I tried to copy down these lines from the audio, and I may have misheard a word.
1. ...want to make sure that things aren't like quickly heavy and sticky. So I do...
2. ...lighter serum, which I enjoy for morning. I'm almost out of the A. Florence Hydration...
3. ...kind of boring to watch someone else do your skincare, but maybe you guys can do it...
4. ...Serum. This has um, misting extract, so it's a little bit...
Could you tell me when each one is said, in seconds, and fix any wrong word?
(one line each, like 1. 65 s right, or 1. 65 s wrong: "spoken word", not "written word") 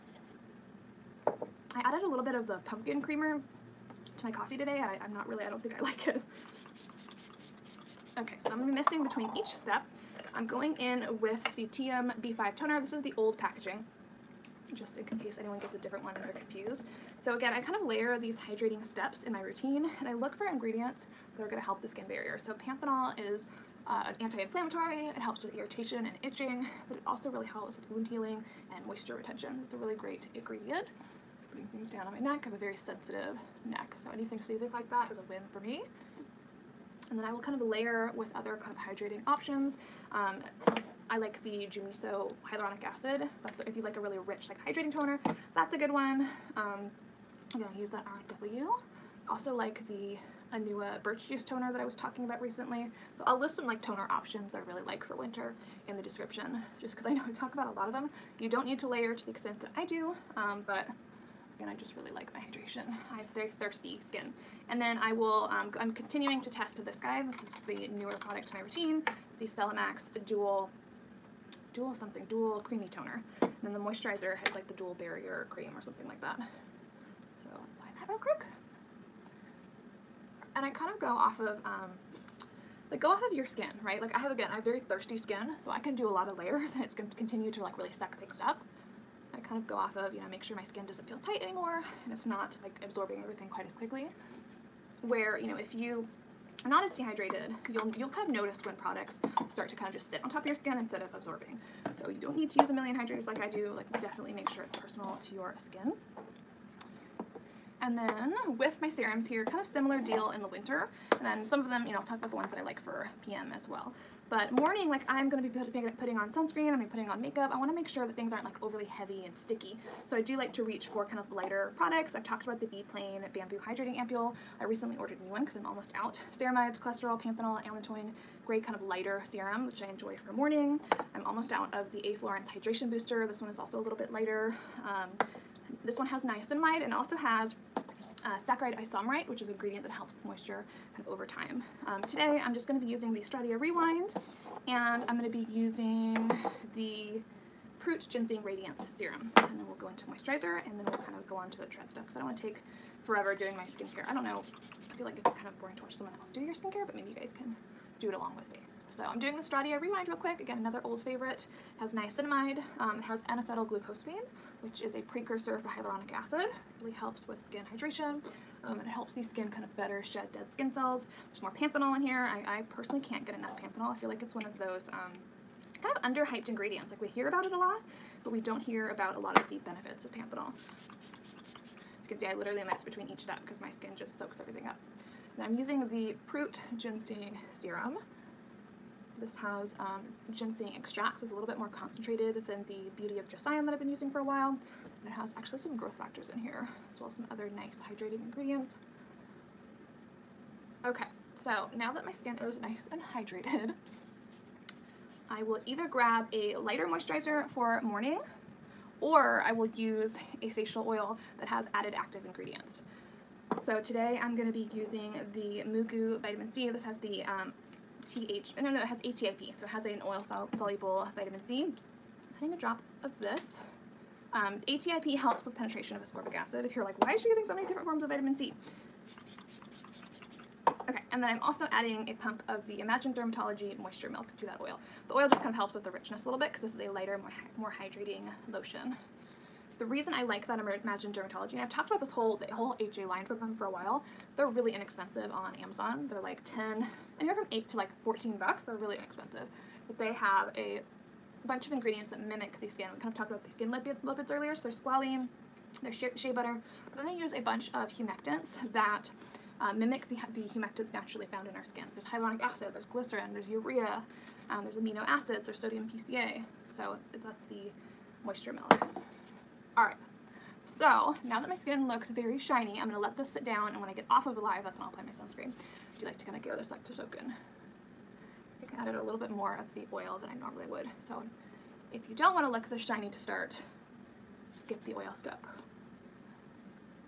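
1. 117 s wrong: "overly", not "quickly"
2. 128 s right
3. 155 s right
4. 187 s wrong: "ginseng", not "misting".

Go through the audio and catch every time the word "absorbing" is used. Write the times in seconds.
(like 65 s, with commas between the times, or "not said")
92 s, 101 s.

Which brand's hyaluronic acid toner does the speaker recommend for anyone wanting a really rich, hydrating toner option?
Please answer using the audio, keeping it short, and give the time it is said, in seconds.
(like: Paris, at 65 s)
Jumiso, at 41 s.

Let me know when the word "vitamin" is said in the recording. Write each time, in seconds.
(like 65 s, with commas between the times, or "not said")
216 s, 221 s, 228 s.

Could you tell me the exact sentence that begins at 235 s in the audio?
The oil just kind of helps with the richness a little bit because this is a lighter, more, more hydrating lotion.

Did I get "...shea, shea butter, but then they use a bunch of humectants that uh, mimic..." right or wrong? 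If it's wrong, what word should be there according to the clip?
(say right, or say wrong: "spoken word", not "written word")
right.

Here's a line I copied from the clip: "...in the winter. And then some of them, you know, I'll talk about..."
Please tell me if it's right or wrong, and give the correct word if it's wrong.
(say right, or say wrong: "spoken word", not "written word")
right.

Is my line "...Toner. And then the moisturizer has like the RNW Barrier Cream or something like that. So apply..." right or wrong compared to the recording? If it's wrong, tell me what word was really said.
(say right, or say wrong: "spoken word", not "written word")
wrong: "Dual", not "RNW".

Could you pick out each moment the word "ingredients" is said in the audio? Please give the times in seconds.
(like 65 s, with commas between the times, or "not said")
20 s, 30 s, 139 s, 176 s, 198 s, 212 s, 251 s.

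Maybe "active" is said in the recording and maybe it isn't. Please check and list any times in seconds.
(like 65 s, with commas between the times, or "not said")
211 s.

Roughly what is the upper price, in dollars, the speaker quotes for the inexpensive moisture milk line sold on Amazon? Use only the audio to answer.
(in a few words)
14.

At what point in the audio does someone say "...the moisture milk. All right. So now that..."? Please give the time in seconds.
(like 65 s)
267 s.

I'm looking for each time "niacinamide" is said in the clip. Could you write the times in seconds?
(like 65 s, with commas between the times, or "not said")
136 s, 161 s.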